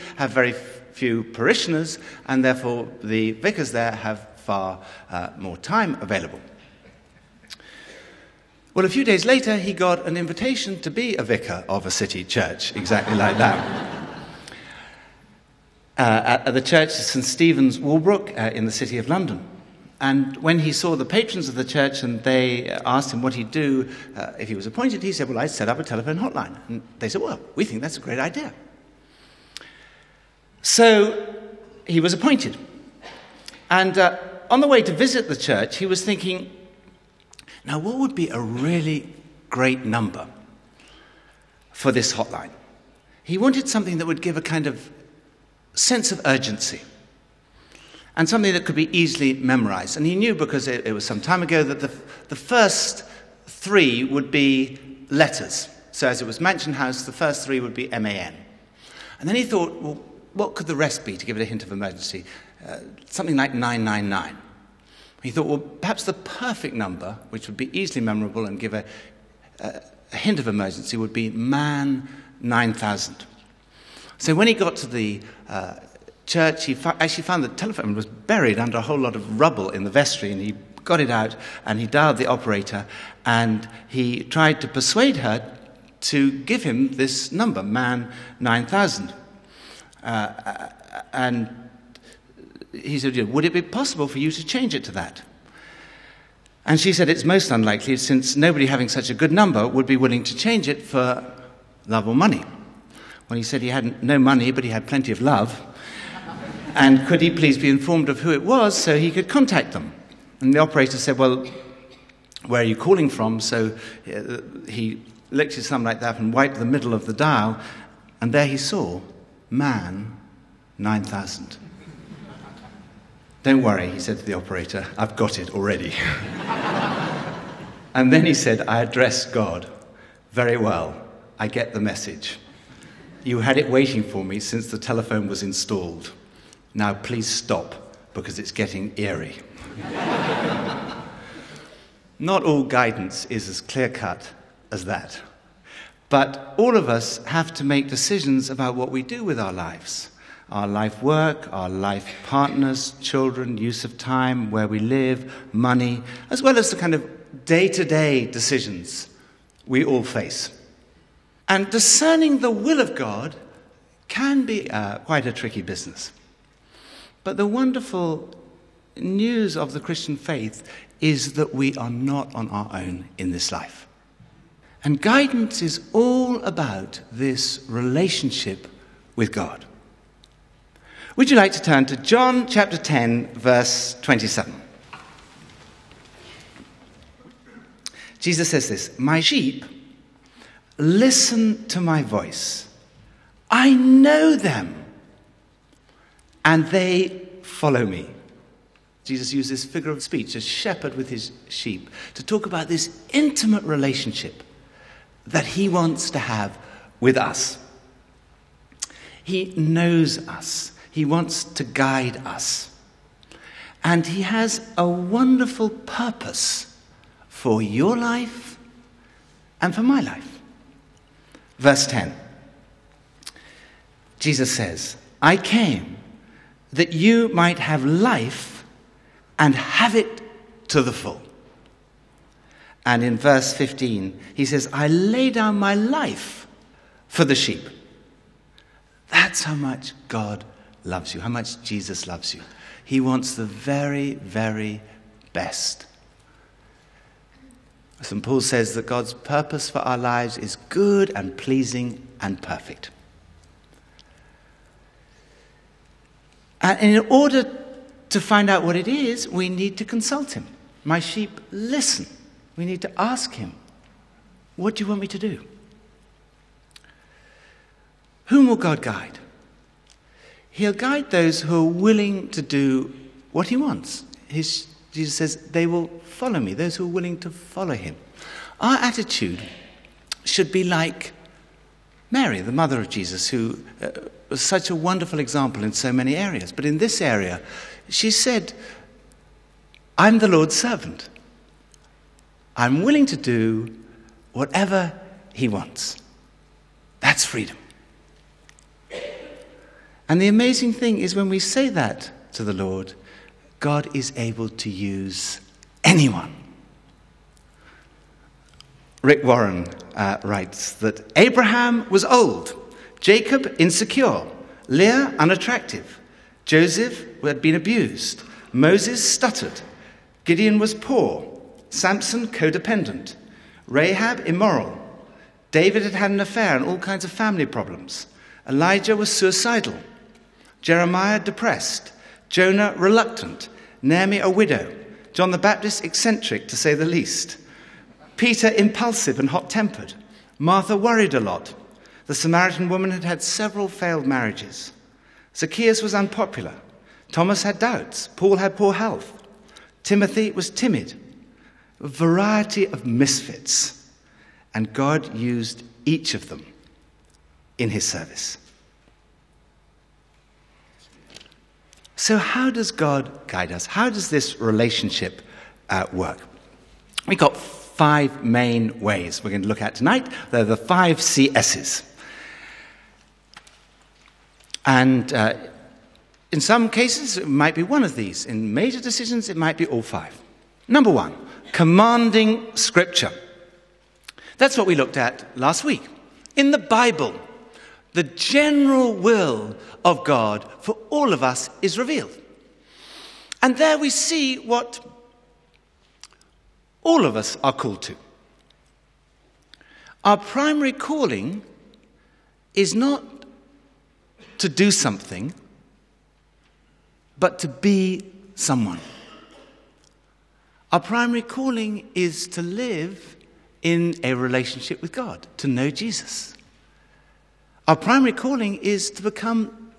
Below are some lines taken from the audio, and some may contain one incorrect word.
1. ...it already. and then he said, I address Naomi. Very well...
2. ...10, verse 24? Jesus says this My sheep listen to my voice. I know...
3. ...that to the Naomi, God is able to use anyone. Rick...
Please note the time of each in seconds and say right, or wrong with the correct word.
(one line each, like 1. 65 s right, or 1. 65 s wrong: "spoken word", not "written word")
1. 125 s wrong: "God", not "Naomi"
2. 182 s wrong: "27", not "24"
3. 301 s wrong: "Lord", not "Naomi".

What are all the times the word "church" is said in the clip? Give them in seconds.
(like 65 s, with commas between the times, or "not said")
12 s, 16 s, 21 s, 35 s, 76 s.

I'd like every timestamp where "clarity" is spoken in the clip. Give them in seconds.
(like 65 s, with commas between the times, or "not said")
not said.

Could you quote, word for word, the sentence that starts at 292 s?
I'm willing to do whatever he wants.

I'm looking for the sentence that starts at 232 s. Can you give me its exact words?
And in verse 15, he says, I lay down my life for the sheep.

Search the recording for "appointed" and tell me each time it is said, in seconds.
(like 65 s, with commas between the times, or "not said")
24 s, 32 s.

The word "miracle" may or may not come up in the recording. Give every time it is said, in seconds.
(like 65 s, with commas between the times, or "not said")
not said.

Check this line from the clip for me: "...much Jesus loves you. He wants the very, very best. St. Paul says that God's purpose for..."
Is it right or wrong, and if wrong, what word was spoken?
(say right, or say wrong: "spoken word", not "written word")
right.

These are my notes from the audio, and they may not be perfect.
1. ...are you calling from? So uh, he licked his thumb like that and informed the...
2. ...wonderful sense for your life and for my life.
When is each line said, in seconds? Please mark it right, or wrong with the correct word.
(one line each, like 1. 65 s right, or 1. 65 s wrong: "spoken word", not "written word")
1. 112 s wrong: "wiped", not "informed"
2. 214 s wrong: "purpose", not "sense".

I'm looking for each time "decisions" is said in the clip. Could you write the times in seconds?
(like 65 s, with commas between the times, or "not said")
147 s, 158 s, 378 s.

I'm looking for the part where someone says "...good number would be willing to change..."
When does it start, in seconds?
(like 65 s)
99 s.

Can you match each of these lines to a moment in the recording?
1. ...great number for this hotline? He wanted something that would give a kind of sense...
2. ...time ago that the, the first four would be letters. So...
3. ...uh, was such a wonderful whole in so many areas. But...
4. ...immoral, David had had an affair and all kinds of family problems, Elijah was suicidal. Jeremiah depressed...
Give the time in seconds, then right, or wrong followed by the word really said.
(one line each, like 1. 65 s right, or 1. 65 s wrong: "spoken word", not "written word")
1. 39 s right
2. 51 s wrong: "three", not "four"
3. 283 s wrong: "example", not "whole"
4. 324 s right.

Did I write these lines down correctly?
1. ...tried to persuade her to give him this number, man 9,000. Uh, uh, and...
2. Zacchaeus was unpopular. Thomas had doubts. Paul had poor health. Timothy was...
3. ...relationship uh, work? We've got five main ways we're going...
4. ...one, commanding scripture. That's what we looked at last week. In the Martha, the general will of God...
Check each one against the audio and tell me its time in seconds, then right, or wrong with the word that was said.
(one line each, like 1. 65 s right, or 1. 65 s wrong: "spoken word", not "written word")
1. 84 s right
2. 345 s right
3. 364 s right
4. 380 s wrong: "Bible", not "Martha".